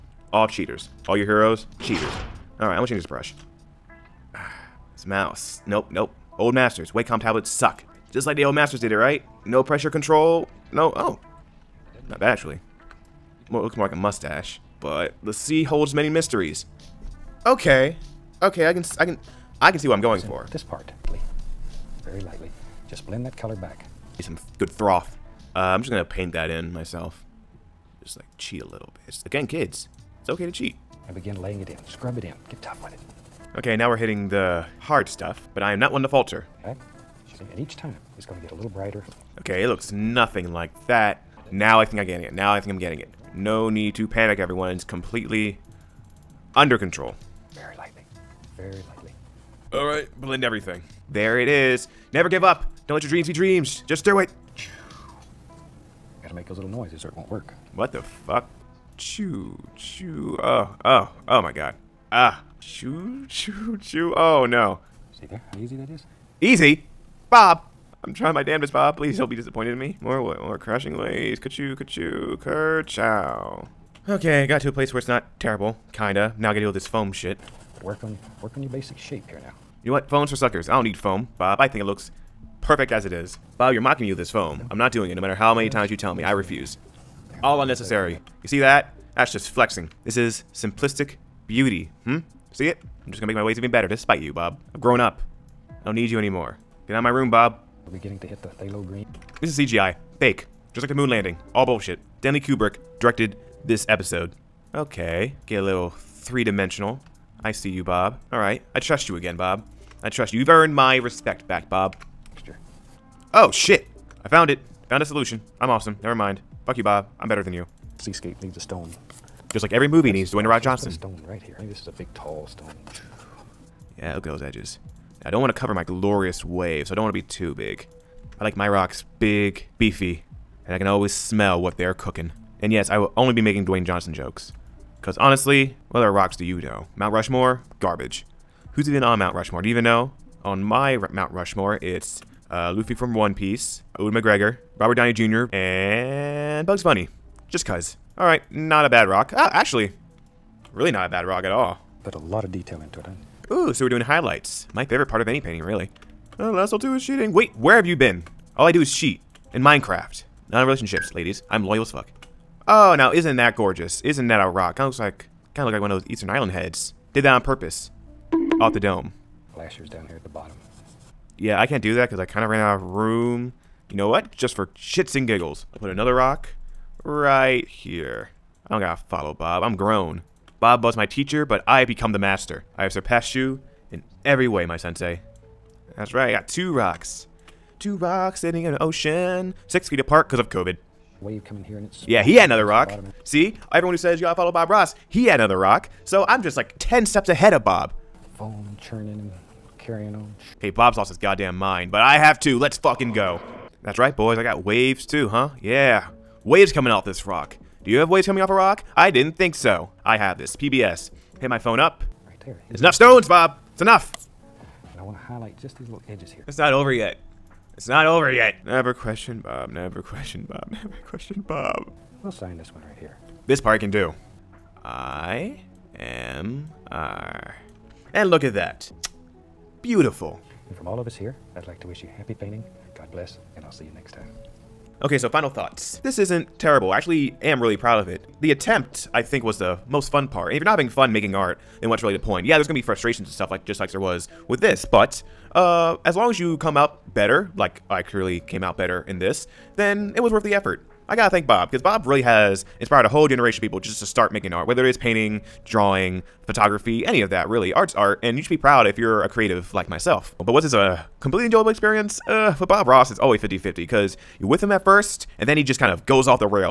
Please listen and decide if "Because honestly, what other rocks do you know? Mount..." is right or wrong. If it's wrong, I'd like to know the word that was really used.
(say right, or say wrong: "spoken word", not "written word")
right.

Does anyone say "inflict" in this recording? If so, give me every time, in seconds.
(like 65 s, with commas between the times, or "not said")
not said.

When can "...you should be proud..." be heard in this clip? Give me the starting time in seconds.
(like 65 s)
258 s.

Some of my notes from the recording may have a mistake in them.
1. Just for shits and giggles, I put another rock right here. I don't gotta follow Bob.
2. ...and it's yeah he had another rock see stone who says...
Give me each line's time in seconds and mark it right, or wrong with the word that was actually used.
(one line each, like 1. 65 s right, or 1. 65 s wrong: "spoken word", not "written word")
1. 174 s right
2. 191 s wrong: "everyone", not "stone".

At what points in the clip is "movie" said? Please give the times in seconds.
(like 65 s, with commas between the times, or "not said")
119 s.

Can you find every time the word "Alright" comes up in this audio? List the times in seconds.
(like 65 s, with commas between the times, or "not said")
49 s, 108 s, 148 s.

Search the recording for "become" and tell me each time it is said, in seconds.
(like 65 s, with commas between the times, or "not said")
181 s.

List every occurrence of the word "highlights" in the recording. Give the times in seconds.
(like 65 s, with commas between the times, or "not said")
154 s, 215 s.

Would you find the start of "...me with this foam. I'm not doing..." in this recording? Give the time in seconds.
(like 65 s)
84 s.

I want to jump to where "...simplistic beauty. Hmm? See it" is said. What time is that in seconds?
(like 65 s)
90 s.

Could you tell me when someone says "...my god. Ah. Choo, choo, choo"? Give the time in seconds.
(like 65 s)
61 s.